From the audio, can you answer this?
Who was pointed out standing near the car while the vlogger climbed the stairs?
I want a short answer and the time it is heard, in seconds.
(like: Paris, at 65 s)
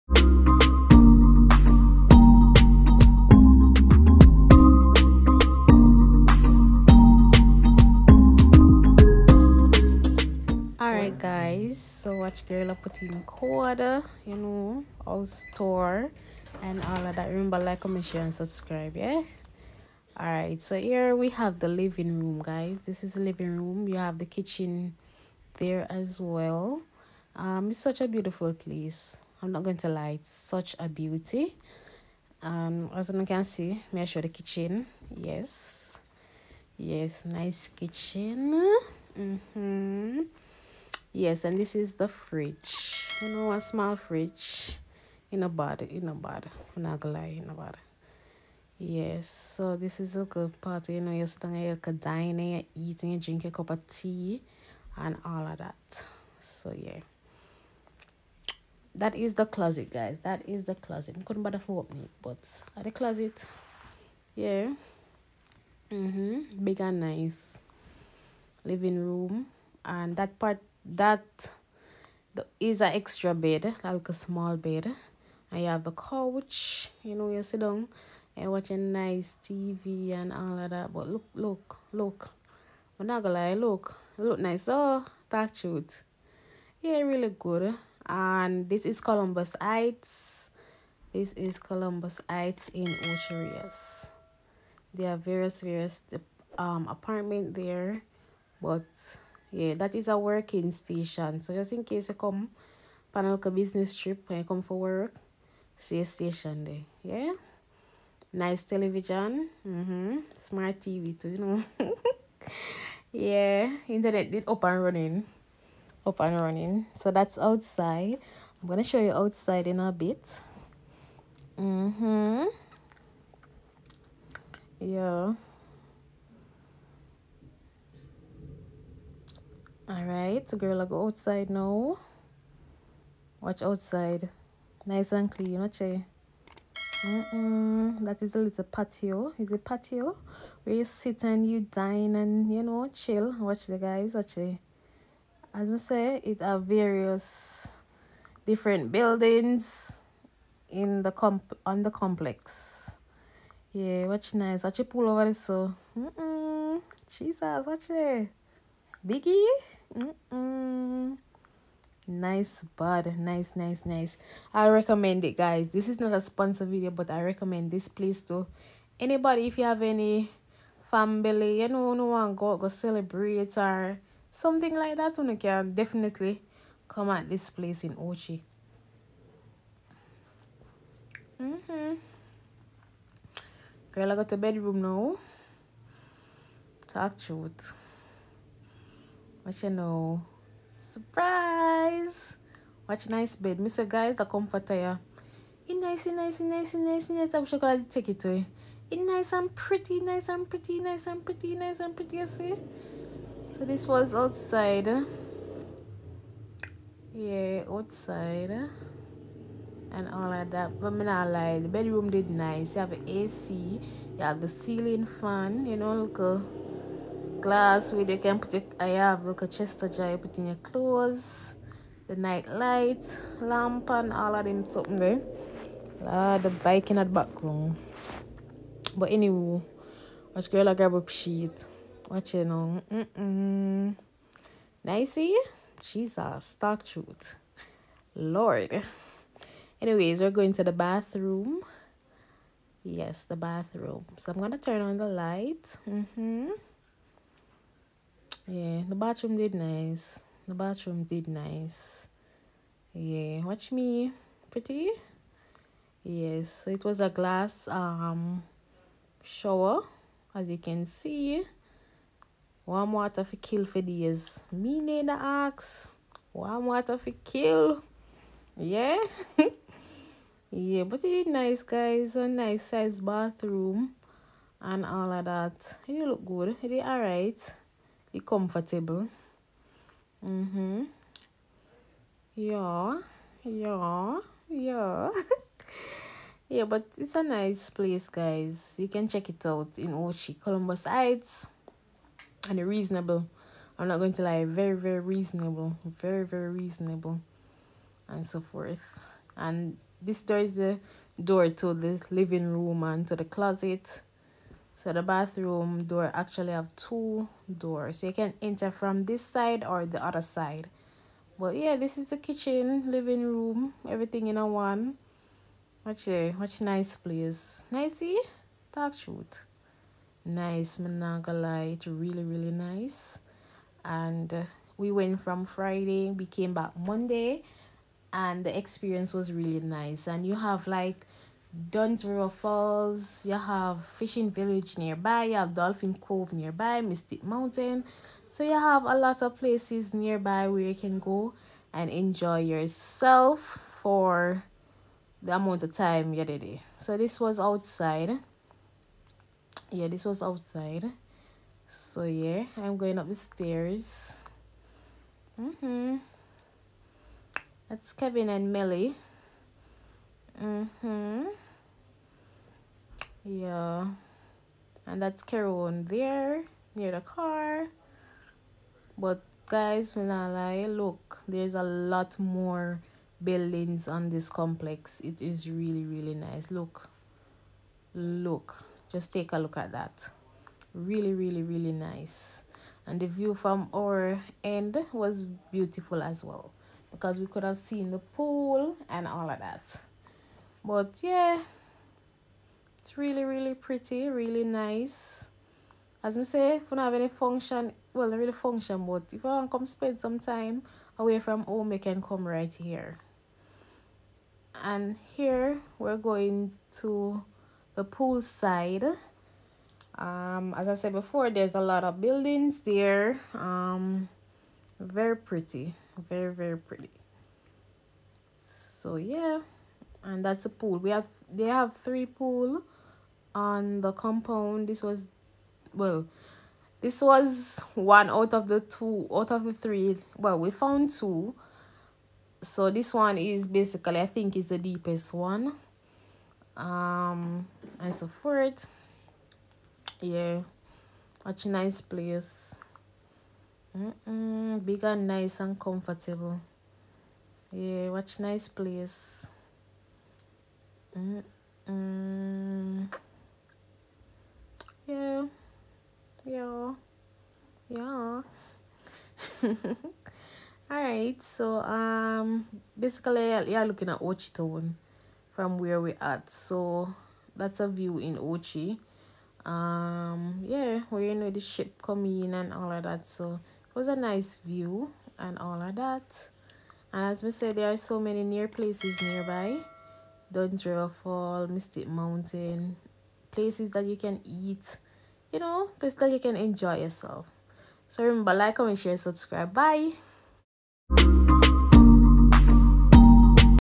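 Kerone, at 365 s.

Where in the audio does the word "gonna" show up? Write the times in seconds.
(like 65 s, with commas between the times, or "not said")
47 s, 83 s, 118 s, 244 s.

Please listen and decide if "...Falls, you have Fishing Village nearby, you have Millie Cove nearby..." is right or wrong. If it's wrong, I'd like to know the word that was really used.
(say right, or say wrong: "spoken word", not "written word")
wrong: "Dolphin", not "Millie".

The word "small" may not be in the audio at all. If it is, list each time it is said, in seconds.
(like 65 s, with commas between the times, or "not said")
43 s, 74 s.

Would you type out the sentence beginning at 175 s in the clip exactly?
You can definitely come at this place in Ochi.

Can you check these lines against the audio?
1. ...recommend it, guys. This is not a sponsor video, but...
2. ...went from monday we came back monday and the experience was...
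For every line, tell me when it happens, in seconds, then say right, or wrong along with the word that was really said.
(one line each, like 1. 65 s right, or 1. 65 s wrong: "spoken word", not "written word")
1. 164 s right
2. 324 s wrong: "friday", not "monday".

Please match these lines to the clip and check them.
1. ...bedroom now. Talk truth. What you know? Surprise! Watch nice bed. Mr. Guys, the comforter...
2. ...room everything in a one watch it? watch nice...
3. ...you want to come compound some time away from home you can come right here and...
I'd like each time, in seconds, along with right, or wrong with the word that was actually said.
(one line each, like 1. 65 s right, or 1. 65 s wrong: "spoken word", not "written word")
1. 184 s right
2. 313 s right
3. 399 s wrong: "spend", not "compound".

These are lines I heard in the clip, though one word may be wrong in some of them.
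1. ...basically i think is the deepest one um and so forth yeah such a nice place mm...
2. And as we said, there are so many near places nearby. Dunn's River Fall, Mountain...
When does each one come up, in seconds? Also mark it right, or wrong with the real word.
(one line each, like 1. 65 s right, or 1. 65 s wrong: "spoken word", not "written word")
1. 433 s right
2. 476 s wrong: "Mystic", not "Mountain".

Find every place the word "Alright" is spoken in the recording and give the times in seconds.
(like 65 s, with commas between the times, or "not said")
20 s, 460 s.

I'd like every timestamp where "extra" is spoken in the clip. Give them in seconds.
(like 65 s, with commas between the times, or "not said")
72 s.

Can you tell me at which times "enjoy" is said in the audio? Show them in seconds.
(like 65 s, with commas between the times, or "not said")
341 s, 486 s.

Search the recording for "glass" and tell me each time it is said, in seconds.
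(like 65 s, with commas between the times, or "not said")
217 s, 257 s.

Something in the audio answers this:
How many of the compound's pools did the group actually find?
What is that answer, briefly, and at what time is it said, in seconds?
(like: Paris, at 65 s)
2, at 430 s.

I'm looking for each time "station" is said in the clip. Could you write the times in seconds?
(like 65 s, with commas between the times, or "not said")
100 s, 106 s.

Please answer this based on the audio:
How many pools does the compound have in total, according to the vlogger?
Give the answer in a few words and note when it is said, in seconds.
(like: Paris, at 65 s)
3, at 421 s.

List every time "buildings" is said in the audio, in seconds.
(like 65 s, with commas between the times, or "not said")
148 s, 373 s, 411 s.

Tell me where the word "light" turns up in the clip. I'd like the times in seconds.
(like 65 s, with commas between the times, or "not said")
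222 s, 245 s.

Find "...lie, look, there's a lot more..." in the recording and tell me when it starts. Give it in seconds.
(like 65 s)
370 s.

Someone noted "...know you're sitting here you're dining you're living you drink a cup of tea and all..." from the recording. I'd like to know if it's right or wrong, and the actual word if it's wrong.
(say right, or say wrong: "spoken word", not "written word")
wrong: "eating", not "living".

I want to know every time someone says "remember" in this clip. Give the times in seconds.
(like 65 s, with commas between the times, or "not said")
17 s, 488 s.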